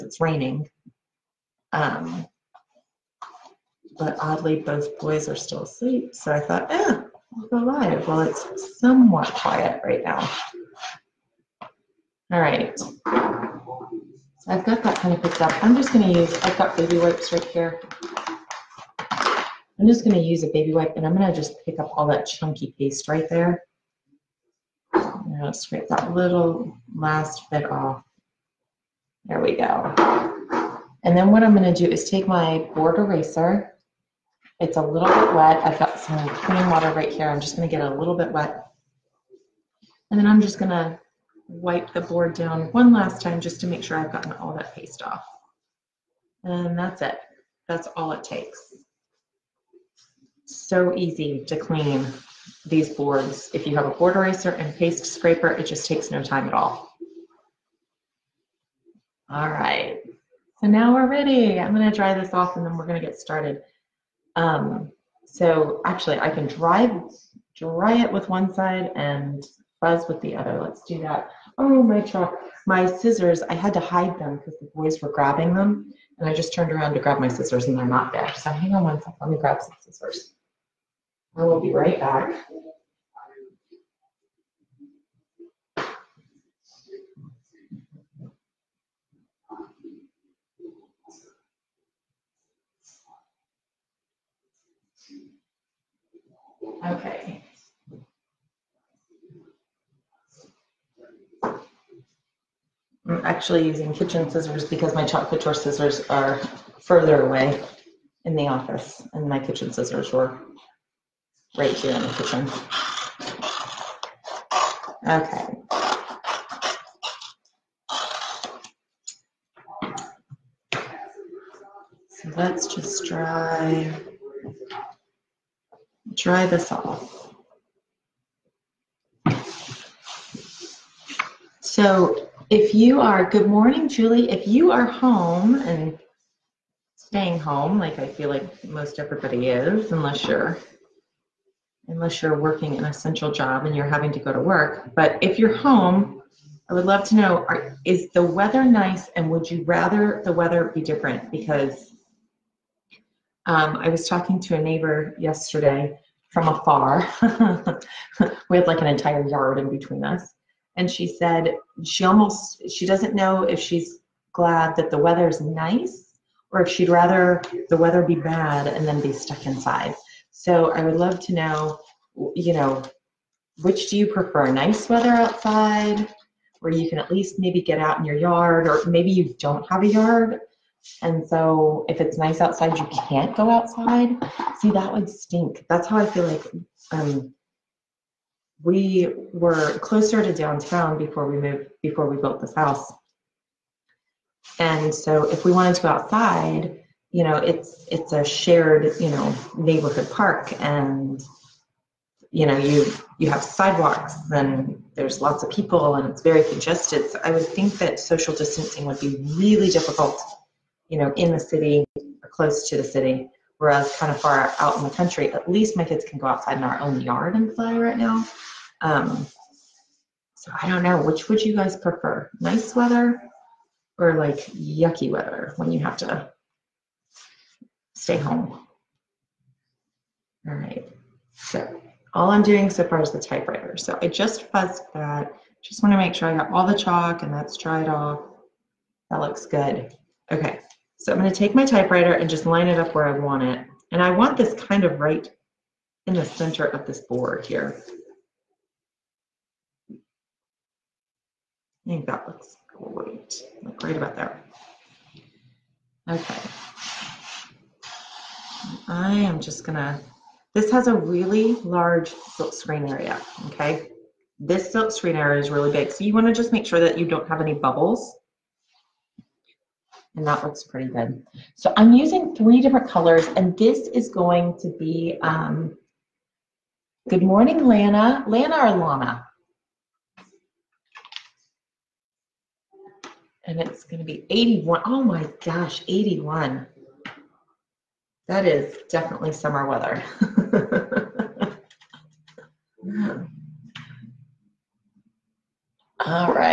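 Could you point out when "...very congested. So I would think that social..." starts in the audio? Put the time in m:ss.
3:26.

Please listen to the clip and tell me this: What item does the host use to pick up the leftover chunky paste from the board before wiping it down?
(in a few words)
Baby wipe.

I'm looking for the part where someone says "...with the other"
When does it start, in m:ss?
1:10.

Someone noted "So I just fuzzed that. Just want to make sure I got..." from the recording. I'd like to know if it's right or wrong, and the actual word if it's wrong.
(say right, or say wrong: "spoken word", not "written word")
right.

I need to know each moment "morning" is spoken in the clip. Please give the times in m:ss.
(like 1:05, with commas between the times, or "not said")
2:13, 4:37.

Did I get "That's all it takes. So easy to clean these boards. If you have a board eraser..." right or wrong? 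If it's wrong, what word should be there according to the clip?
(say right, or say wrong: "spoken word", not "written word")
right.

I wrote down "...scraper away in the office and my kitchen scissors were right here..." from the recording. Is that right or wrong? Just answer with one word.
wrong.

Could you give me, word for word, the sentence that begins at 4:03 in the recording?
And I want this kind of right in the center of this board here.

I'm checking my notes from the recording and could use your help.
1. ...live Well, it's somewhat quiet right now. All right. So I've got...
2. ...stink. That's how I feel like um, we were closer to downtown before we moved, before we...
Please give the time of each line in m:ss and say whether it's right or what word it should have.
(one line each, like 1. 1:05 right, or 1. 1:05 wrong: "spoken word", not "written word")
1. 0:07 right
2. 3:05 right.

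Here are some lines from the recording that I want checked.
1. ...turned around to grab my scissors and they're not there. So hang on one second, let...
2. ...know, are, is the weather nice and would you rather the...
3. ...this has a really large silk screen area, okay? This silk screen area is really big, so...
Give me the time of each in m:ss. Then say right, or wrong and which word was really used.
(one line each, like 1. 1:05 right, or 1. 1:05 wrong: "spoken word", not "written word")
1. 1:16 right
2. 2:27 right
3. 4:20 right.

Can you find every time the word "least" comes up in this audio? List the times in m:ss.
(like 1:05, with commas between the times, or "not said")
2:57, 3:35.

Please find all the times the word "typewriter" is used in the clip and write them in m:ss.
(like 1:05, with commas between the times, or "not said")
3:53, 4:01.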